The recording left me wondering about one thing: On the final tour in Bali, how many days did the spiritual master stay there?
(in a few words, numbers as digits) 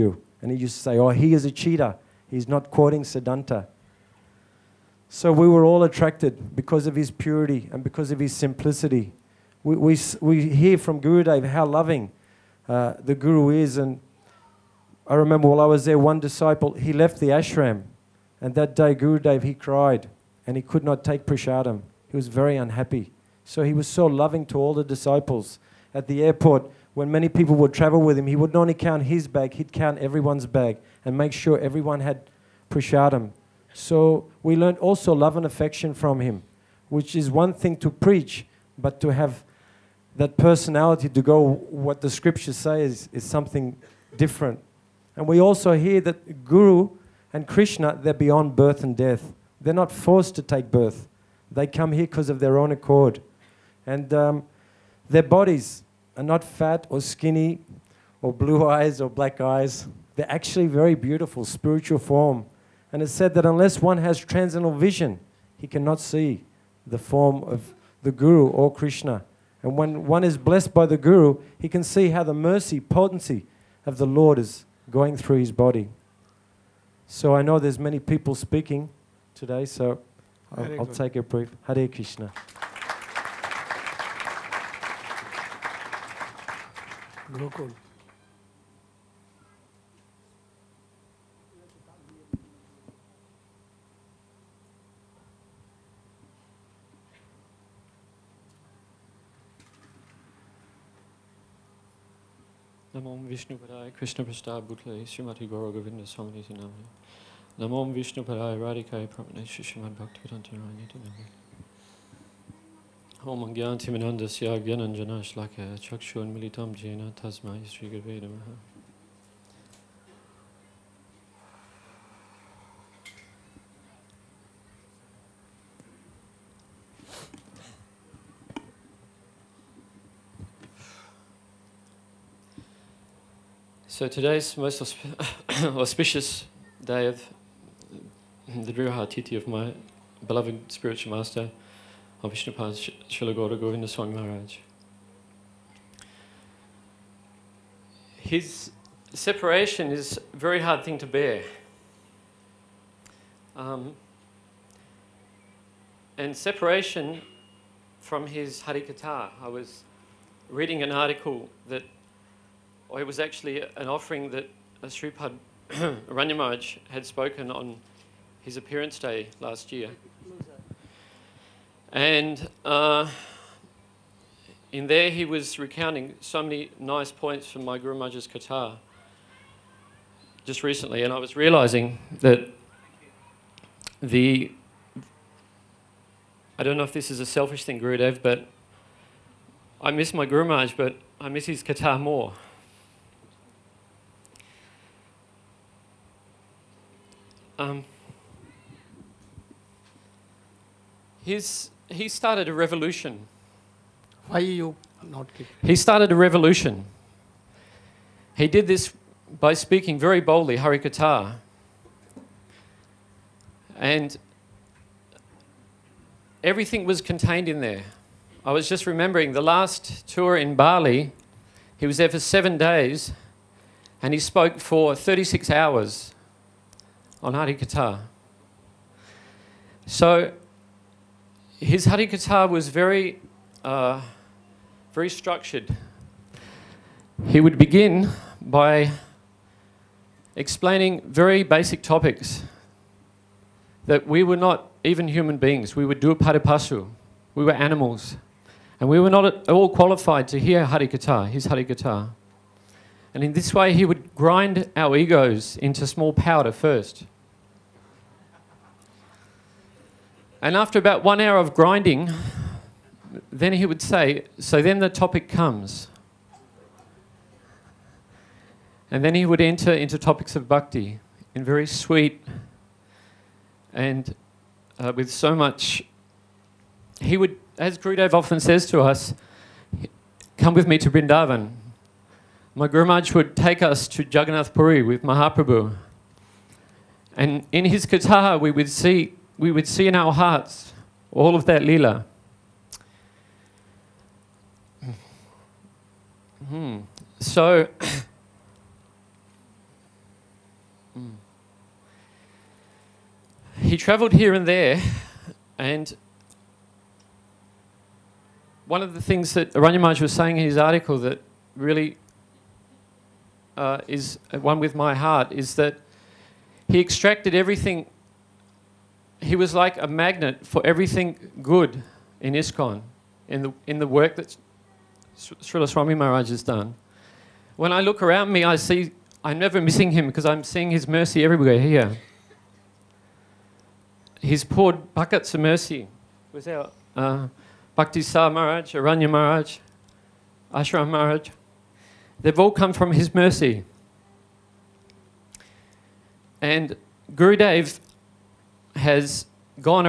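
7.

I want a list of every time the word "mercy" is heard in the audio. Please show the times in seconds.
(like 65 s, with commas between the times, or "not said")
72 s, 330 s, 335 s, 343 s.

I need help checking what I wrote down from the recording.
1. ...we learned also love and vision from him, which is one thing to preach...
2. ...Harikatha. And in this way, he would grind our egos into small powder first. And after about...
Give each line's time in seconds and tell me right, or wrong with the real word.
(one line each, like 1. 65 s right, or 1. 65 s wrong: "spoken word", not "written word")
1. 34 s wrong: "affection", not "vision"
2. 251 s right.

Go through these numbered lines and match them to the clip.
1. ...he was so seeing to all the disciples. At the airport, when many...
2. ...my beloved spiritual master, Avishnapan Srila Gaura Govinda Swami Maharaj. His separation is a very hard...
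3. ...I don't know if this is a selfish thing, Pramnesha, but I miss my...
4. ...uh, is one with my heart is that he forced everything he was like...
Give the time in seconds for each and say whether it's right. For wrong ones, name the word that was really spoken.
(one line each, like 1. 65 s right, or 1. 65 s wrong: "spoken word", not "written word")
1. 23 s wrong: "loving", not "seeing"
2. 139 s right
3. 186 s wrong: "Gurudev", not "Pramnesha"
4. 313 s wrong: "extracted", not "forced".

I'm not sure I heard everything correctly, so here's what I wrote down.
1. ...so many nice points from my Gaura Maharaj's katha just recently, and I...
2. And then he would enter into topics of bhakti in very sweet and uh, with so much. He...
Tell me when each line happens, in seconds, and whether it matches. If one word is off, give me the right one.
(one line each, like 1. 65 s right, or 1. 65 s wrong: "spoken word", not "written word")
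1. 176 s wrong: "Guru", not "Gaura"
2. 268 s right.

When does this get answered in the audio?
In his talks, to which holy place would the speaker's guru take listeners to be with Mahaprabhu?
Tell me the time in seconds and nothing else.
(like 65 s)
284 s.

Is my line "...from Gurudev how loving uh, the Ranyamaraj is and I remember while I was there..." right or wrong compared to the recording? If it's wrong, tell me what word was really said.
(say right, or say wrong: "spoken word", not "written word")
wrong: "Guru", not "Ranyamaraj".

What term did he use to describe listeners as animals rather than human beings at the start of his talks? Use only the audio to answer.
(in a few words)
duapadipasu.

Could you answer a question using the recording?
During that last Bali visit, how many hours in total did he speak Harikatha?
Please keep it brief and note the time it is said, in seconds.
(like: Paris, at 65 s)
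36, at 224 s.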